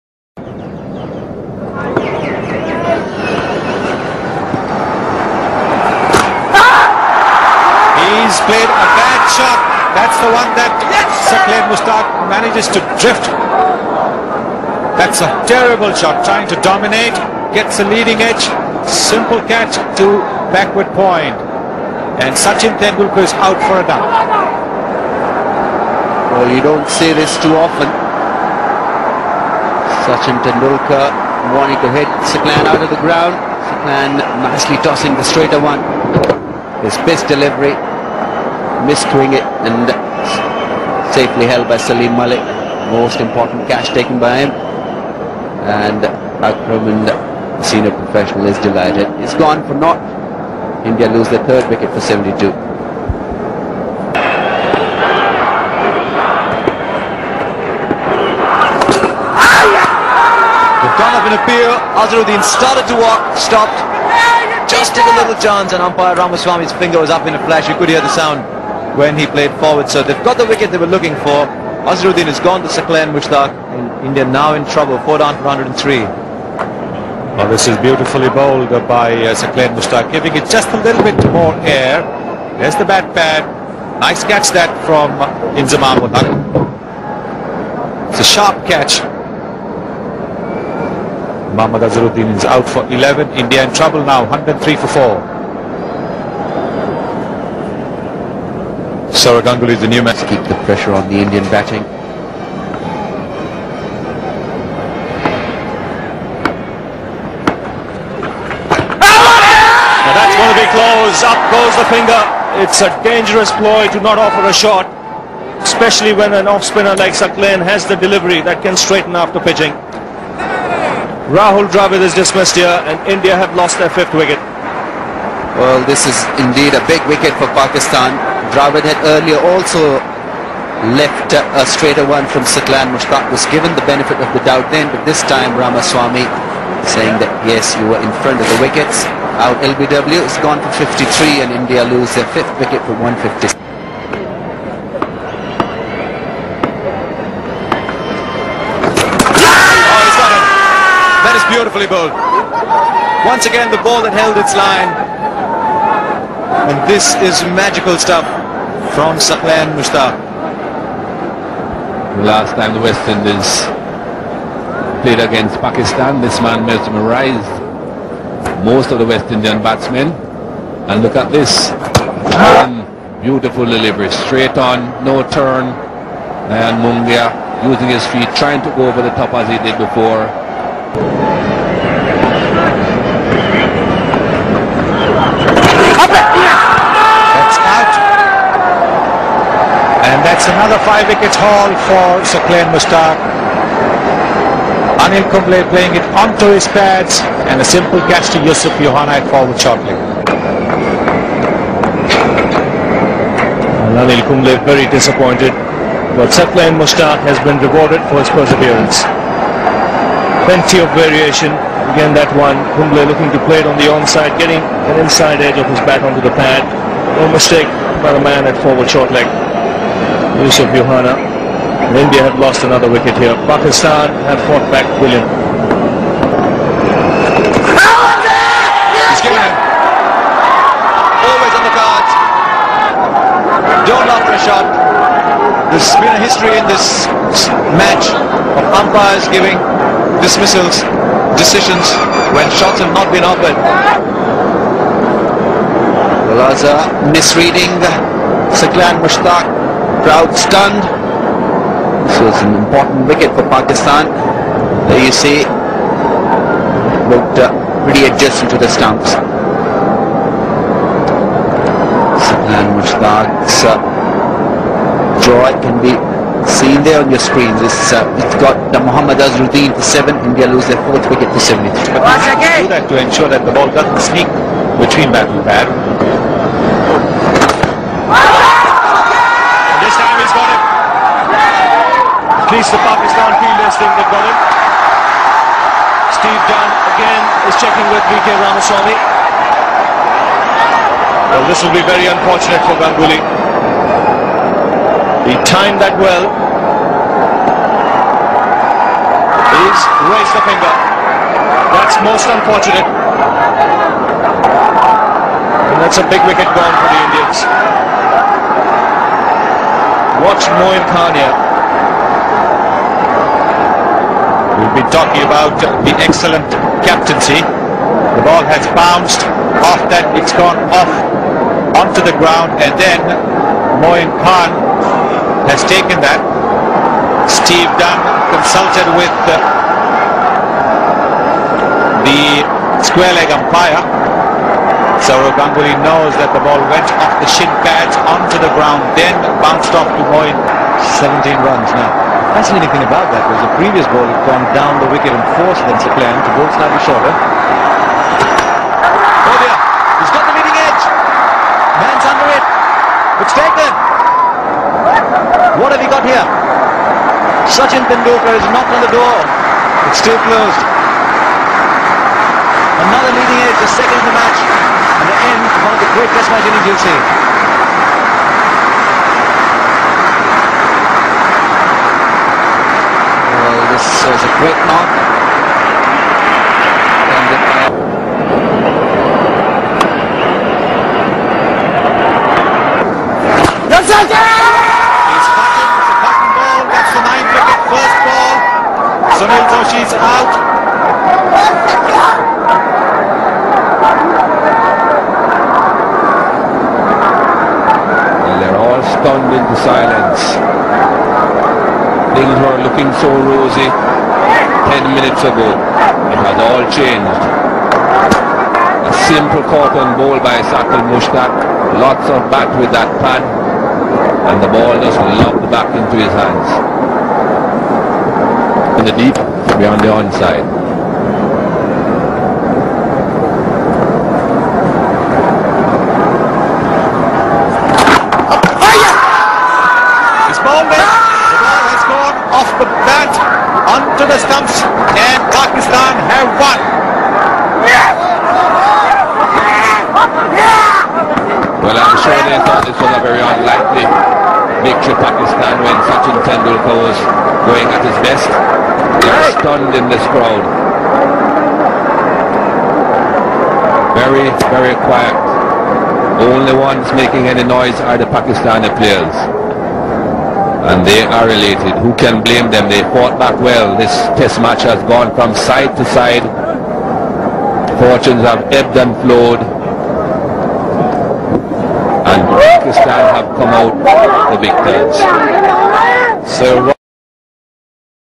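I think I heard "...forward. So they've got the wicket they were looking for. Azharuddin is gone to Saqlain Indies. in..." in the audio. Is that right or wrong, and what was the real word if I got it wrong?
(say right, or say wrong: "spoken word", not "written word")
wrong: "Mushtaq", not "Indies".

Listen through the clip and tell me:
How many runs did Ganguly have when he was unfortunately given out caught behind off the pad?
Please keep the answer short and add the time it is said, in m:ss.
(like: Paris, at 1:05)
17, at 5:41.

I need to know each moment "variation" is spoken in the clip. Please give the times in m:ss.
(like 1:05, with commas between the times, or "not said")
3:30.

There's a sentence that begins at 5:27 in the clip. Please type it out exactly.
Steve Dunn consulted with the, uh, the square leg umpire.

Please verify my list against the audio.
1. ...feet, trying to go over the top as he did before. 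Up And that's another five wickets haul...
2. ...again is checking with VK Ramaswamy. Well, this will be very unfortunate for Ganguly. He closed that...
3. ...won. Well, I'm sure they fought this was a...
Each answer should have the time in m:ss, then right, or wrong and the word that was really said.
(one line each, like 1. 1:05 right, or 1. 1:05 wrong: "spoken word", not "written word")
1. 2:58 right
2. 4:46 wrong: "timed", not "closed"
3. 7:16 wrong: "thought", not "fought".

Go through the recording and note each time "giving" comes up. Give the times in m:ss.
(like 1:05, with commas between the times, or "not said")
1:20, 3:59.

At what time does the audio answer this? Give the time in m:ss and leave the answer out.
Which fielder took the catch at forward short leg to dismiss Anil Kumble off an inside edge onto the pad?
3:40.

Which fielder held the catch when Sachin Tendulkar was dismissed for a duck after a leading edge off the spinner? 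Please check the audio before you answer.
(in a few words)
Salim Malik.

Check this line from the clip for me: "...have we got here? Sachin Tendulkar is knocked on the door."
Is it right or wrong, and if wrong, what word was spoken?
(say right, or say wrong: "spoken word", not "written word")
right.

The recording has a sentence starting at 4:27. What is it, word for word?
This uh, it's got the uh, Muhammad Azharuddin for seven.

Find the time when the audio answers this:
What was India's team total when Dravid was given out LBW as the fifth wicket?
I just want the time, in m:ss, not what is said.
2:22.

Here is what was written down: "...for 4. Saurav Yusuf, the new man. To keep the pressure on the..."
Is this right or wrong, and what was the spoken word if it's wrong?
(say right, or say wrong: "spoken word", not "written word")
wrong: "Ganguly", not "Yusuf".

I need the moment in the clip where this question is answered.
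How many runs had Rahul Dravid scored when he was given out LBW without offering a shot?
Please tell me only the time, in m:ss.
2:20.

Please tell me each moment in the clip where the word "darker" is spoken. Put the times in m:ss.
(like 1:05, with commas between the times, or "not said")
not said.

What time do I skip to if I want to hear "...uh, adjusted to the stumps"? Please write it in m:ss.
4:17.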